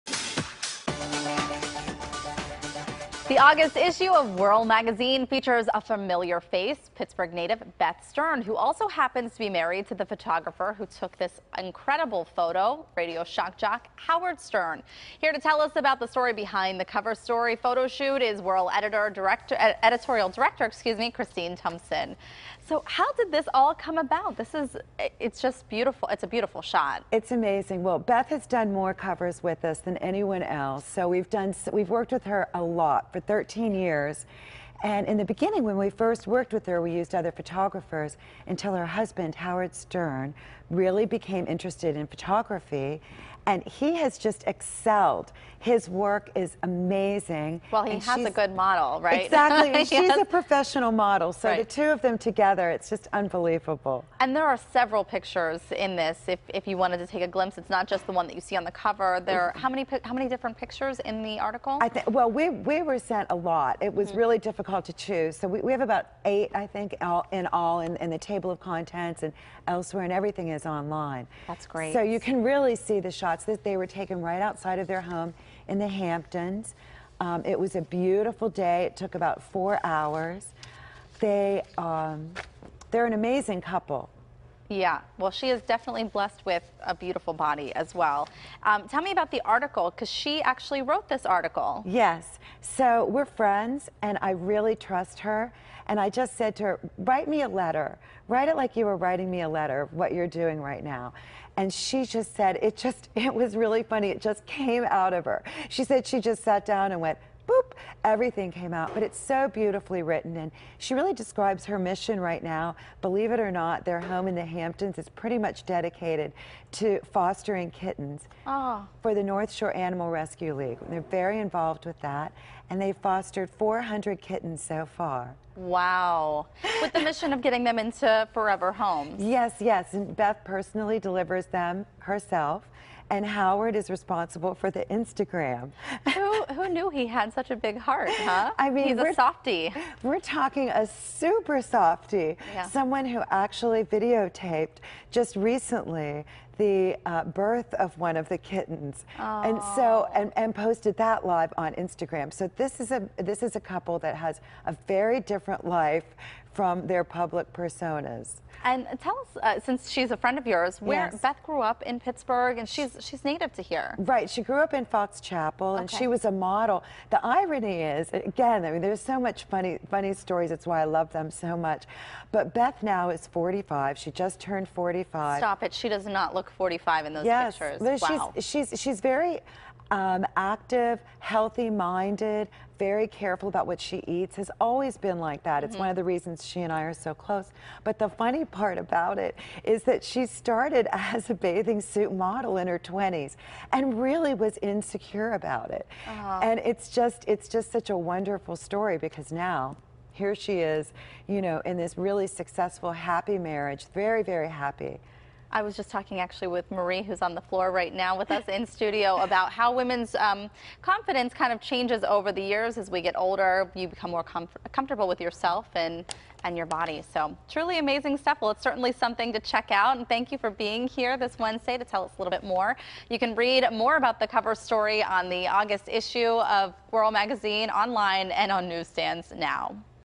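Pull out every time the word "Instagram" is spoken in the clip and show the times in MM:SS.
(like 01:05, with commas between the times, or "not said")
02:14, 02:31.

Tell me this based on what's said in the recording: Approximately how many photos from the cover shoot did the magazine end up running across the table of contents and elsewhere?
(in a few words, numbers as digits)
8.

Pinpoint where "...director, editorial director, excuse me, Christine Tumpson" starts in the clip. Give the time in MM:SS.
00:19.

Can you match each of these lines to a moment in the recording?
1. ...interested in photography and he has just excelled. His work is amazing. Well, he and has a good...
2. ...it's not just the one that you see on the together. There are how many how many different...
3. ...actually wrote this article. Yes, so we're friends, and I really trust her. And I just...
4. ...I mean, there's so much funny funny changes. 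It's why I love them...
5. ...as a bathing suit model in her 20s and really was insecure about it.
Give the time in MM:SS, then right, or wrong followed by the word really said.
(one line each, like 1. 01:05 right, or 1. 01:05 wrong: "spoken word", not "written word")
1. 00:41 right
2. 00:57 wrong: "cover", not "together"
3. 01:30 right
4. 02:48 wrong: "stories", not "changes"
5. 03:11 right.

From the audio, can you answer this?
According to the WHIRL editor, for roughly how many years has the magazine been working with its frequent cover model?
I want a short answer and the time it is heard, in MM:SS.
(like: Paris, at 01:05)
13 years, at 00:33.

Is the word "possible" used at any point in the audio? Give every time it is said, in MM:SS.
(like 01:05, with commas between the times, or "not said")
not said.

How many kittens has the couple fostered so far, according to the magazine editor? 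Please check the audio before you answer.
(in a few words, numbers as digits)
400.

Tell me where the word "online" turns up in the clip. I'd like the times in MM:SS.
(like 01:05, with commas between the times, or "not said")
01:10, 03:47.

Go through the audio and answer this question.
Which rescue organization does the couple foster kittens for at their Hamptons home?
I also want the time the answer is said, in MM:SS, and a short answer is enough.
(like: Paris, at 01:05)
North Shore Animal Rescue League, at 01:59.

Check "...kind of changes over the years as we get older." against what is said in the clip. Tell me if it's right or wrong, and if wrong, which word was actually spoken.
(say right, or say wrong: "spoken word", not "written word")
right.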